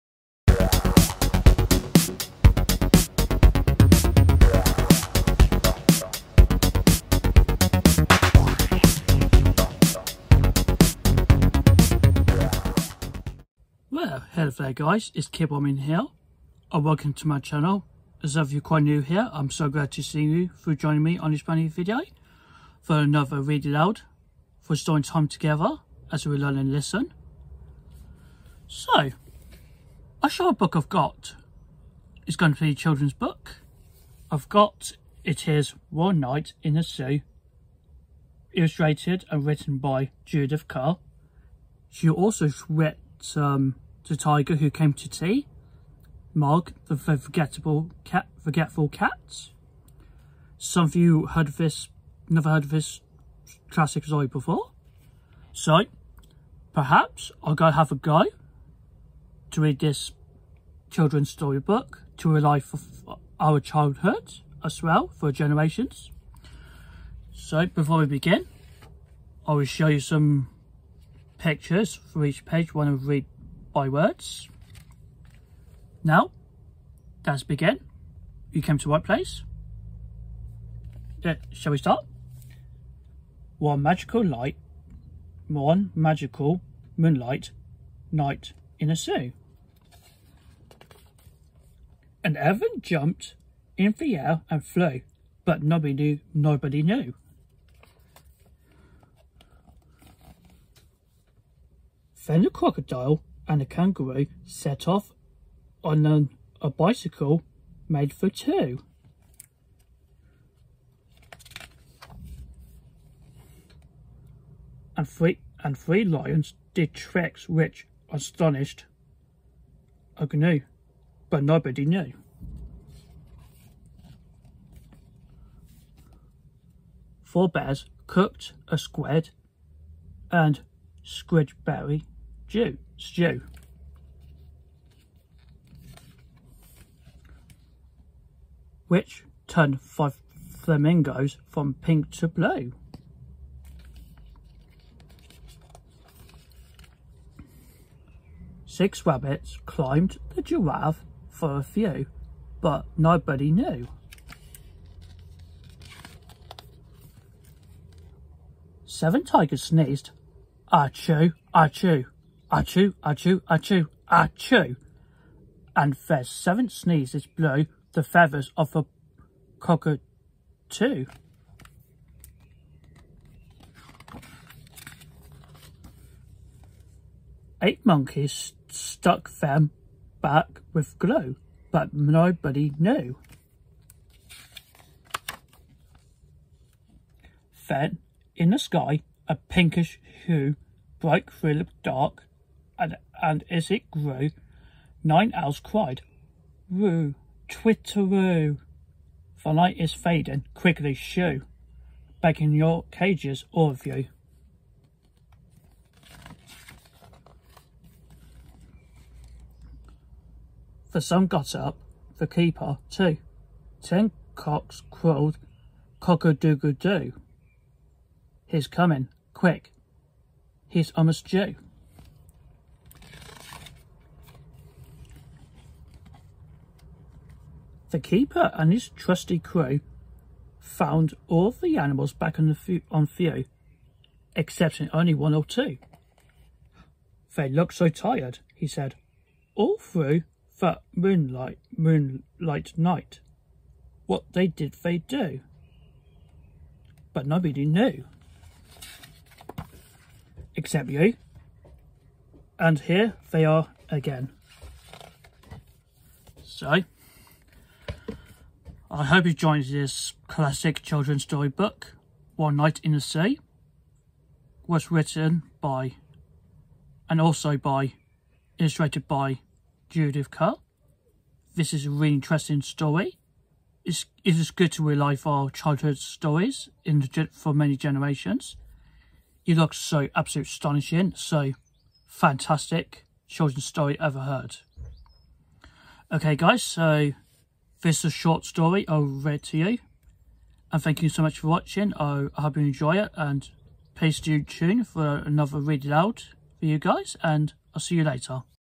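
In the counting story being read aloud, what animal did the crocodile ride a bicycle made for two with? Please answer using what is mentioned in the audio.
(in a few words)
kangaroo.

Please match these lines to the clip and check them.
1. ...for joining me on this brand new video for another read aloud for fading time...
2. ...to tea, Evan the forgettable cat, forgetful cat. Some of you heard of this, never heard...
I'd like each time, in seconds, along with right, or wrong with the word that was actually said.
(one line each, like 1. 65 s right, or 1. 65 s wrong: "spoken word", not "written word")
1. 20 s wrong: "storing", not "fading"
2. 44 s wrong: "Mog", not "Evan".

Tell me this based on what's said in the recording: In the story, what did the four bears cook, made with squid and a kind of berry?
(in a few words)
squid and squidberry stew.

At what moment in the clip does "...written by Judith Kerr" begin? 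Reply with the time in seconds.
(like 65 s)
39 s.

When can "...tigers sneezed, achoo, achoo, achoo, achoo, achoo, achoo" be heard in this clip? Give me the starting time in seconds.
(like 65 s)
159 s.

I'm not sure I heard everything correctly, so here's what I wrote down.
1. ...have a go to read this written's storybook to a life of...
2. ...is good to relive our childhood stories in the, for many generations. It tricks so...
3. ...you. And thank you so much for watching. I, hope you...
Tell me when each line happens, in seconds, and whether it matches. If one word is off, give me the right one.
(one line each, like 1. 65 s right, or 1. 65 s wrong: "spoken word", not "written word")
1. 57 s wrong: "children", not "written"
2. 274 s wrong: "looks", not "tricks"
3. 289 s right.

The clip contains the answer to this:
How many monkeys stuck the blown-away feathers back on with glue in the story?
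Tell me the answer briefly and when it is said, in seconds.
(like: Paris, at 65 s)
8, at 177 s.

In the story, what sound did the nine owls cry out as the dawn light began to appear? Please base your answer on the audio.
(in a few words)
Roo, twitteroo.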